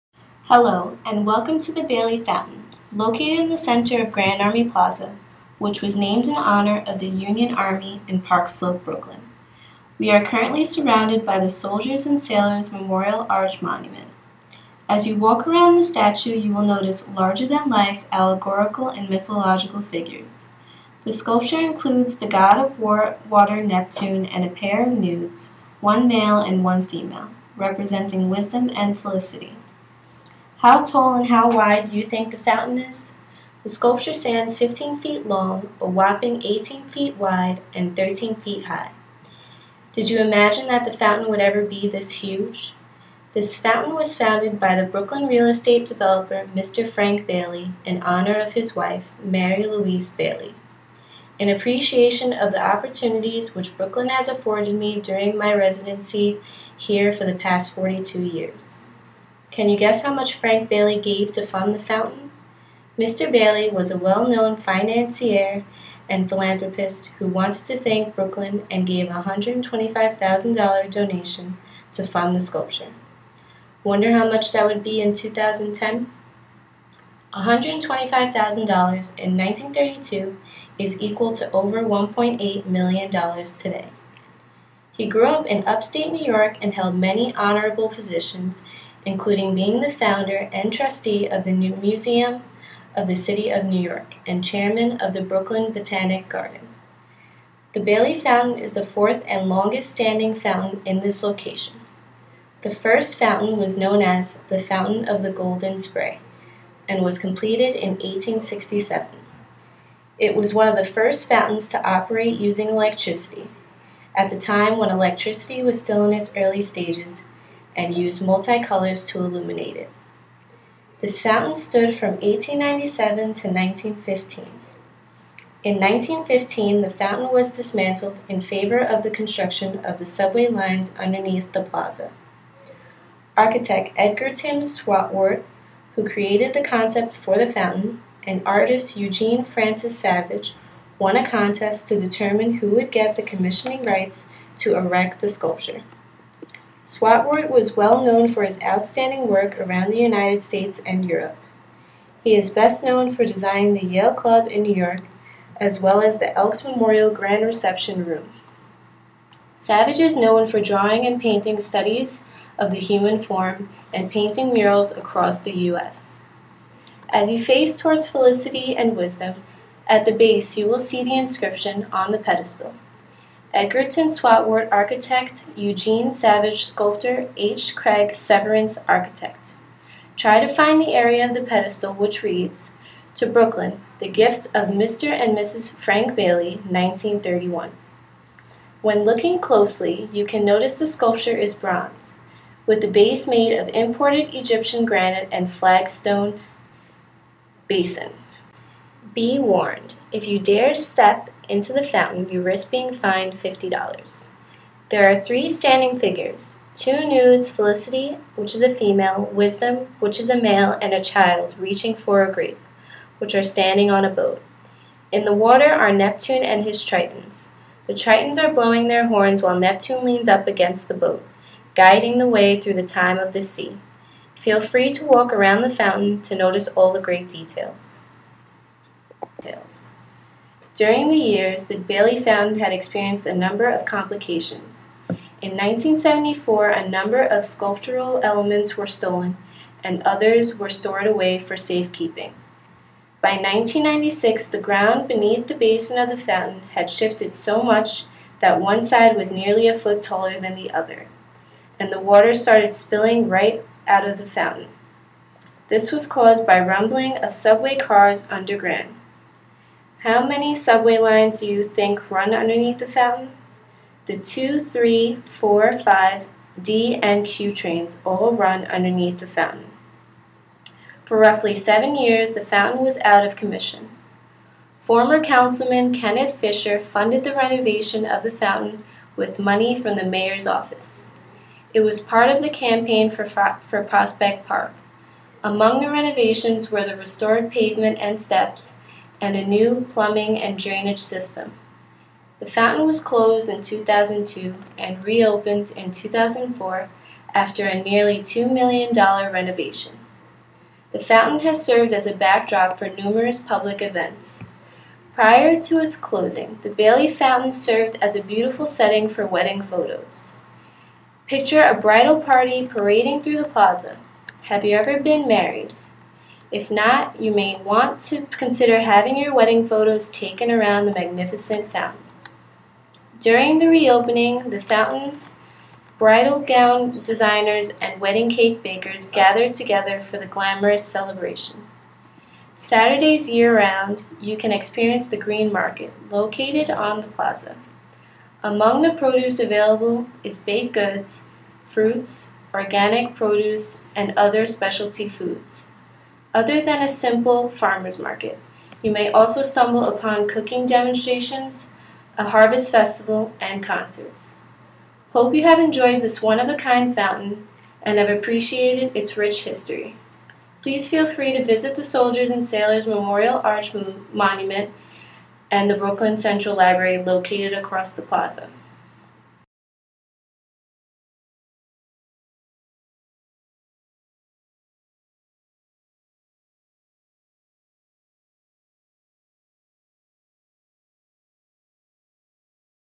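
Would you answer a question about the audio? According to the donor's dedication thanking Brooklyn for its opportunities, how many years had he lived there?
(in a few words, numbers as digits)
42.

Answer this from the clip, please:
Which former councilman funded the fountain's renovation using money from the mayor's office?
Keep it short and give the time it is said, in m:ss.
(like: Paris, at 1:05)
Kenneth Fisher, at 4:35.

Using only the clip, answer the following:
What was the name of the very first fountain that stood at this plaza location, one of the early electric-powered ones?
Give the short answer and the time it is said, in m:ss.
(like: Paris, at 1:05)
Fountain of the Golden Spray, at 1:44.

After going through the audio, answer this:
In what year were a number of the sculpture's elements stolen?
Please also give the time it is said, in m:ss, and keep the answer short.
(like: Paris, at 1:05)
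1974, at 3:55.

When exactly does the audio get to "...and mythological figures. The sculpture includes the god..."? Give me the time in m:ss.
0:18.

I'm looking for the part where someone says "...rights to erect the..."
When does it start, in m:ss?
2:23.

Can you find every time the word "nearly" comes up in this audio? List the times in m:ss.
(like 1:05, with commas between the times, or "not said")
4:09, 4:57.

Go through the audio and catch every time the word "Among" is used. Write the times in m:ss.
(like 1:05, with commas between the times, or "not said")
4:45, 5:38.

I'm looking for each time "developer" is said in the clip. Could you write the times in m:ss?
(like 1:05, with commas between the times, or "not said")
0:45.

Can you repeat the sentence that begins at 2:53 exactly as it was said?
Edgerton Swartwout, architect, Eugene Savage, sculptor, H.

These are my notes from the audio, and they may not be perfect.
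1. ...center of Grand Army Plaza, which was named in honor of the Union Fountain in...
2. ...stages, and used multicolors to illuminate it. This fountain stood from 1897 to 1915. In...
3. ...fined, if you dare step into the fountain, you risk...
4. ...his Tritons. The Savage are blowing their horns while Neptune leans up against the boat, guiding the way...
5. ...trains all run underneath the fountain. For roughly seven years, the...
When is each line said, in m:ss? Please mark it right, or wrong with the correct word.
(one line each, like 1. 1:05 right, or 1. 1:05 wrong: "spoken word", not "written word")
1. 0:03 wrong: "Army", not "Fountain"
2. 1:56 right
3. 3:19 wrong: "warned", not "fined"
4. 3:36 wrong: "Tritons", not "Savage"
5. 4:27 right.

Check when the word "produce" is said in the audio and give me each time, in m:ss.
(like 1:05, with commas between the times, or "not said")
5:38, 5:43.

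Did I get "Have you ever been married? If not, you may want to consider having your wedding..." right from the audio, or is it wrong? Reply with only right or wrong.
right.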